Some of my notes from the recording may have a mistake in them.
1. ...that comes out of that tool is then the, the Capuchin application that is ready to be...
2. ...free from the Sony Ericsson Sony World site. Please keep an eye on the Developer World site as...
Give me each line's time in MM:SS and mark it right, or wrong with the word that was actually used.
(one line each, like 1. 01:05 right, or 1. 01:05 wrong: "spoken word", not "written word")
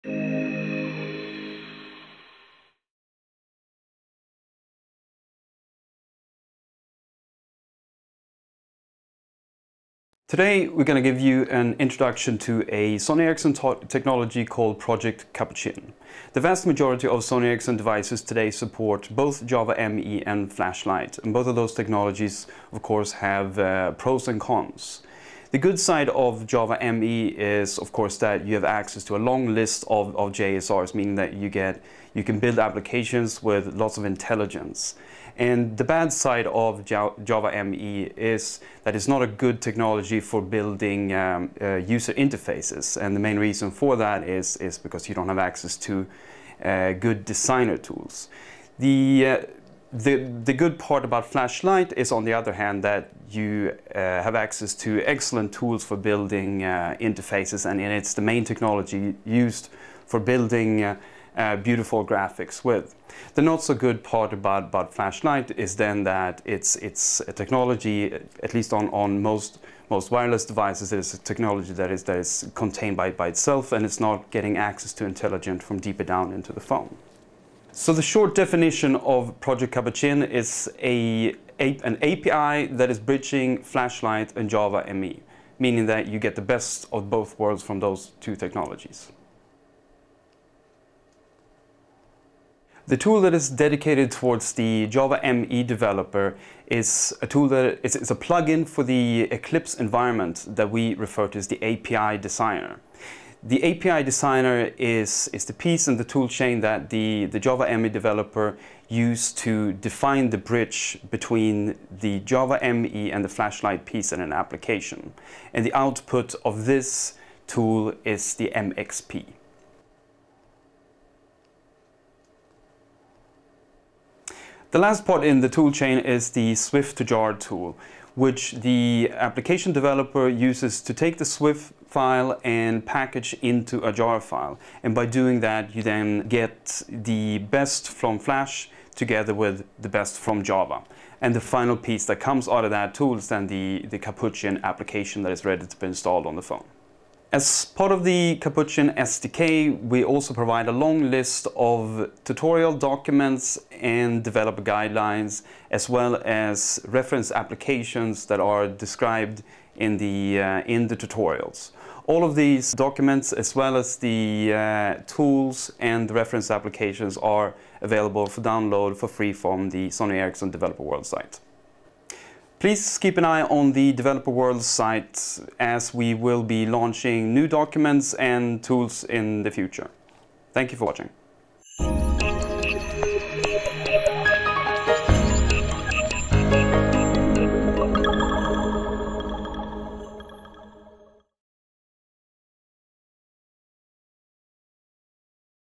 1. 02:22 right
2. 02:49 wrong: "Developer", not "Sony".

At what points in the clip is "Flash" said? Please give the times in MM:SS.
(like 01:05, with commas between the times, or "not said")
00:20, 00:51, 01:04, 01:23, 01:53, 02:18.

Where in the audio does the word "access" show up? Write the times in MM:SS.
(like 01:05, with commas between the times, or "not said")
00:28, 00:45, 00:54, 01:14.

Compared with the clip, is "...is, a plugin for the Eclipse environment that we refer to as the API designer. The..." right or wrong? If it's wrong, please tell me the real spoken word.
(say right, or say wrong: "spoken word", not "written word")
right.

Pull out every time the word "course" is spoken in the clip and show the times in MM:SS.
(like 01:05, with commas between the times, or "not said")
00:22, 00:27.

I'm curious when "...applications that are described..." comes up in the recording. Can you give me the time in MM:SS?
02:37.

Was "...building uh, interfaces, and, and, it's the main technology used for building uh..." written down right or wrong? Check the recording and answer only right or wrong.
right.